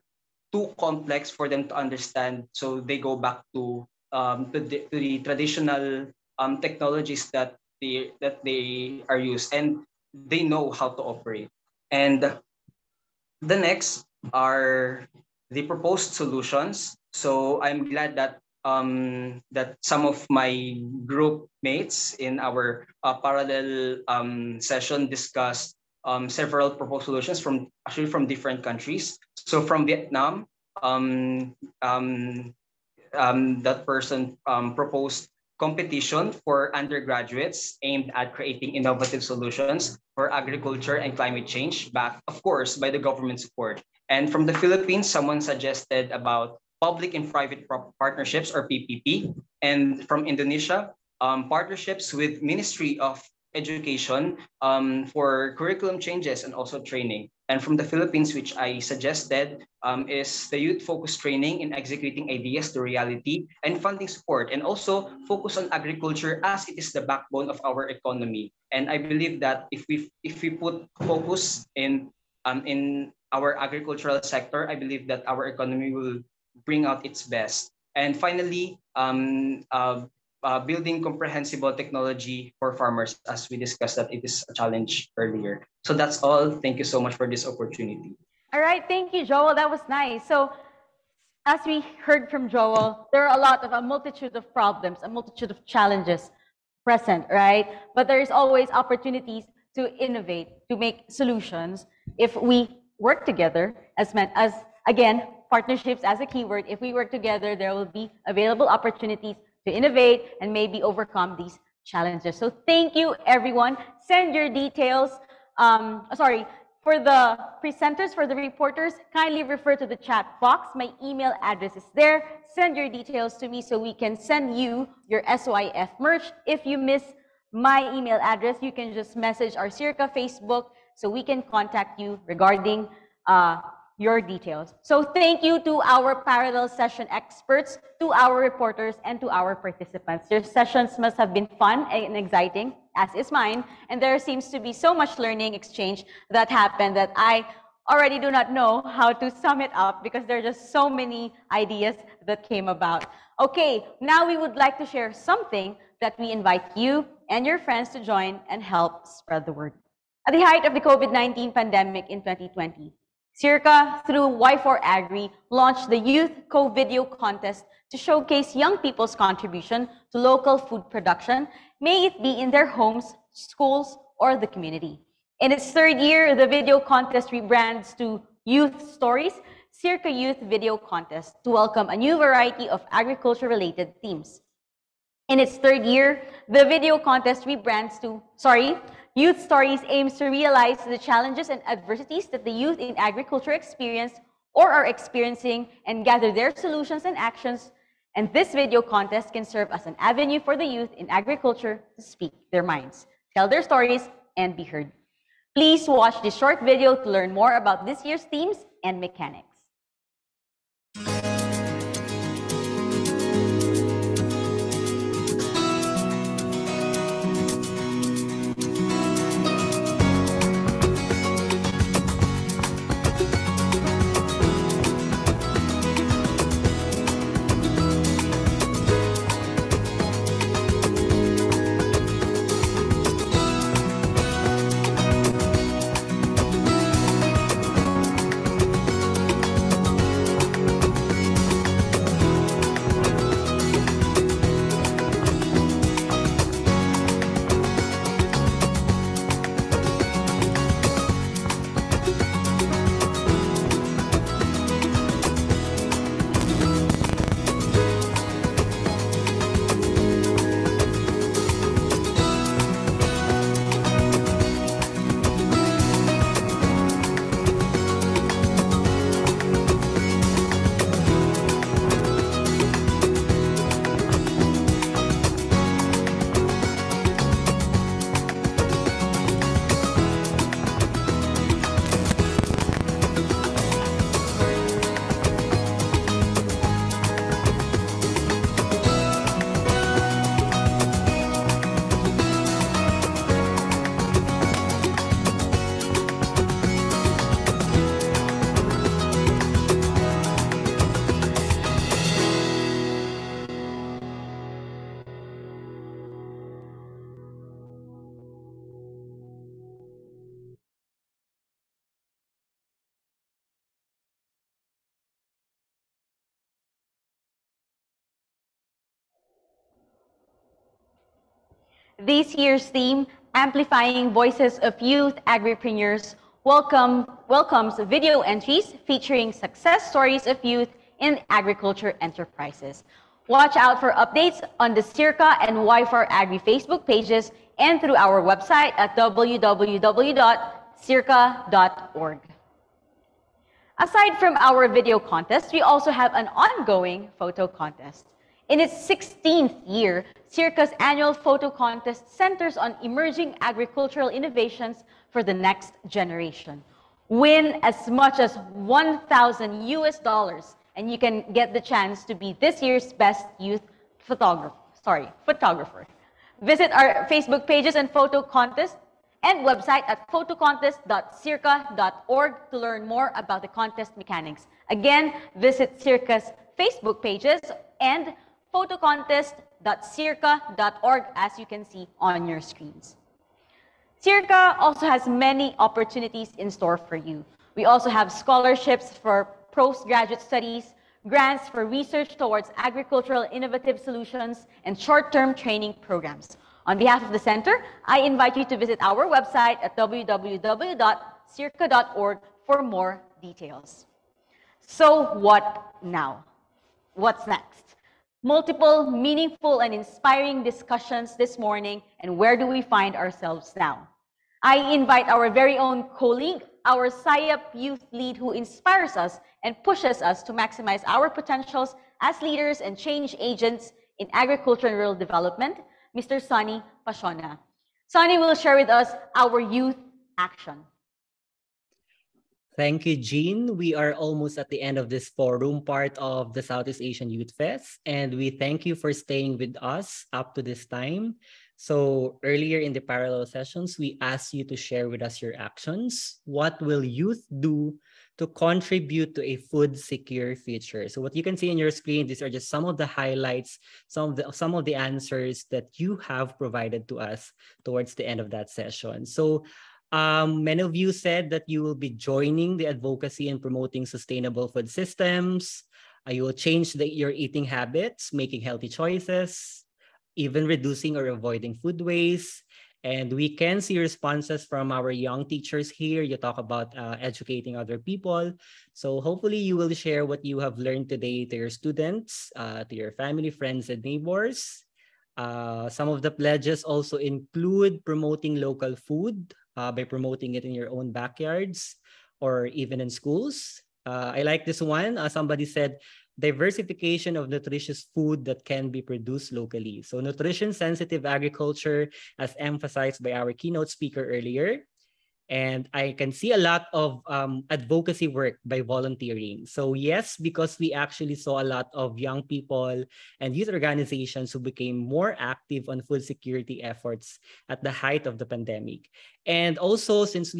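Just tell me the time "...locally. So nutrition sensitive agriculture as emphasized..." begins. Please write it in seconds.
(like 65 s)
499 s.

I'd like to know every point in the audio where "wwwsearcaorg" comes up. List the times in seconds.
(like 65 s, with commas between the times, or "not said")
338 s, 399 s.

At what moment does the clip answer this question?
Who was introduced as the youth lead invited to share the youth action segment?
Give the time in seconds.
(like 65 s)
426 s.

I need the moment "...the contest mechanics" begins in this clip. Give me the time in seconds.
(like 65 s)
373 s.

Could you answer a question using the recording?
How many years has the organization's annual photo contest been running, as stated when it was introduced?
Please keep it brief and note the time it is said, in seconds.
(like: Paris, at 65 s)
16, at 348 s.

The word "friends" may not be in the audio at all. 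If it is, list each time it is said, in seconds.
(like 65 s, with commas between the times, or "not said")
157 s, 483 s.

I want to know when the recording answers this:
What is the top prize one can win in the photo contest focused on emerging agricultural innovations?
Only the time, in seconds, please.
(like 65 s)
358 s.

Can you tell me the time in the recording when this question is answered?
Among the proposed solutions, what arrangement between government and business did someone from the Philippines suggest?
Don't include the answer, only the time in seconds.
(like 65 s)
46 s.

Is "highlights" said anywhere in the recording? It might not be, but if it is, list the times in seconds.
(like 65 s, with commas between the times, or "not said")
452 s.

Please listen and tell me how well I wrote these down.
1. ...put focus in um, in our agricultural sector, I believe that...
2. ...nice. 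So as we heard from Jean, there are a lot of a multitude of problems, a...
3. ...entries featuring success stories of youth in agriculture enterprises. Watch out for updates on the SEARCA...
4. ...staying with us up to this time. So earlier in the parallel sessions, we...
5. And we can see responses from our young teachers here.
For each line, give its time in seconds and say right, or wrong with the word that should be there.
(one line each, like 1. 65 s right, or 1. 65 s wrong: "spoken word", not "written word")
1. 70 s right
2. 89 s wrong: "Joel", not "Jean"
3. 328 s right
4. 438 s right
5. 472 s right.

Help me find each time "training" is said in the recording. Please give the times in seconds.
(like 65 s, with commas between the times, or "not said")
56 s, 61 s, 395 s.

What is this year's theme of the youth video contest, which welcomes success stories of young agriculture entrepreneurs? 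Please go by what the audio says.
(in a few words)
Amplifying Voices of Youth Agripreneurs.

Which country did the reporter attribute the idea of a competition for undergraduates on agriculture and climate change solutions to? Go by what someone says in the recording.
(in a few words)
Vietnam.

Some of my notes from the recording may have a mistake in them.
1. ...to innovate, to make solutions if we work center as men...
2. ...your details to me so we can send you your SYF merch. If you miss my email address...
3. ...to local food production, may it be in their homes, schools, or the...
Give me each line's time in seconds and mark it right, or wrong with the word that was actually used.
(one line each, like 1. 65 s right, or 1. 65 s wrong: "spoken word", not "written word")
1. 99 s wrong: "together", not "center"
2. 122 s right
3. 170 s right.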